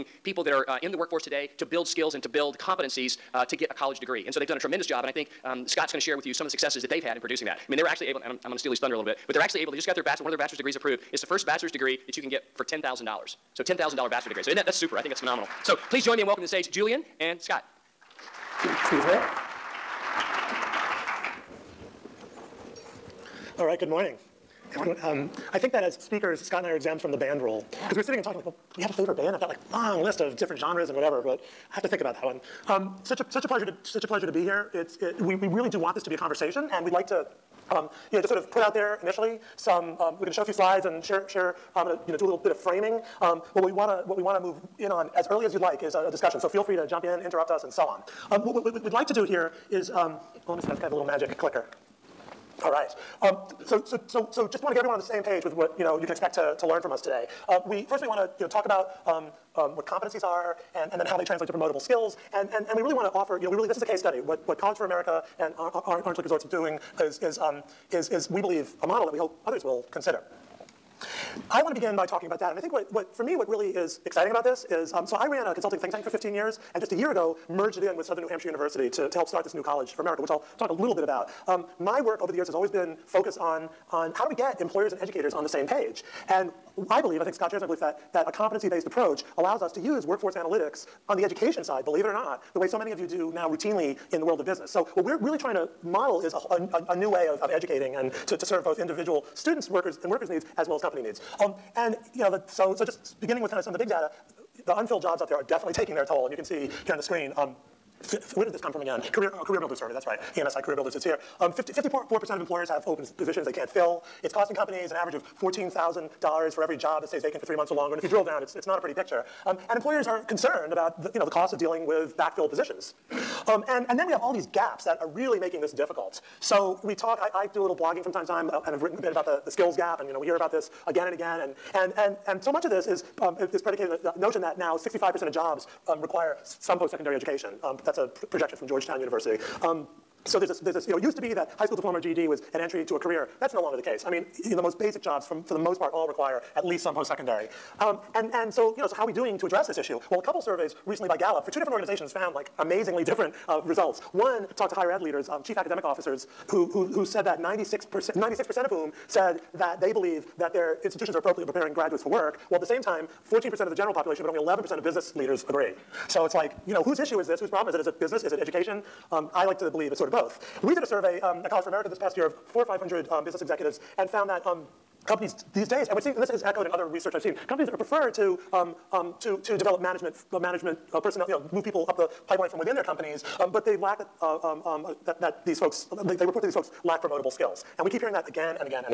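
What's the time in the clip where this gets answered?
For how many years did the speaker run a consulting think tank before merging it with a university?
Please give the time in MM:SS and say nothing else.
01:16.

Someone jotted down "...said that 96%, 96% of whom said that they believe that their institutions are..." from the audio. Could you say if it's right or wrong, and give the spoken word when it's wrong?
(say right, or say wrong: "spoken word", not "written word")
right.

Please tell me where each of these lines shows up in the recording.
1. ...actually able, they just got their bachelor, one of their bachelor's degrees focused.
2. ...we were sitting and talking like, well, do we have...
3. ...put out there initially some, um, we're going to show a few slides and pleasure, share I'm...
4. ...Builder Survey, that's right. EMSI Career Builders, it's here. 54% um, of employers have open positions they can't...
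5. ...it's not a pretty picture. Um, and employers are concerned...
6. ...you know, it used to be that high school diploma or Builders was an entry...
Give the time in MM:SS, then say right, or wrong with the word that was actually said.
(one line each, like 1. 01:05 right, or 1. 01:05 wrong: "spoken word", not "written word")
1. 00:09 wrong: "approved", not "focused"
2. 00:27 right
3. 00:38 wrong: "share", not "pleasure"
4. 01:49 right
5. 01:58 right
6. 02:20 wrong: "GED", not "Builders".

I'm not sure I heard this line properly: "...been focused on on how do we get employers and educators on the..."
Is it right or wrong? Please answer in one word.
right.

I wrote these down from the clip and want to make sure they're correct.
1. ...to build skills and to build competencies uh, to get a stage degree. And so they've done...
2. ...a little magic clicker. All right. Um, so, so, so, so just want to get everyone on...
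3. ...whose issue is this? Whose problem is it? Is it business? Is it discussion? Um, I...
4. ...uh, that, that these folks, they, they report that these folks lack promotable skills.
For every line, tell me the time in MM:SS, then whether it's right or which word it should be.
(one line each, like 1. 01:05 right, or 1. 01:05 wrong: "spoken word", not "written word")
1. 00:01 wrong: "college", not "stage"
2. 00:50 right
3. 02:46 wrong: "education", not "discussion"
4. 03:04 right.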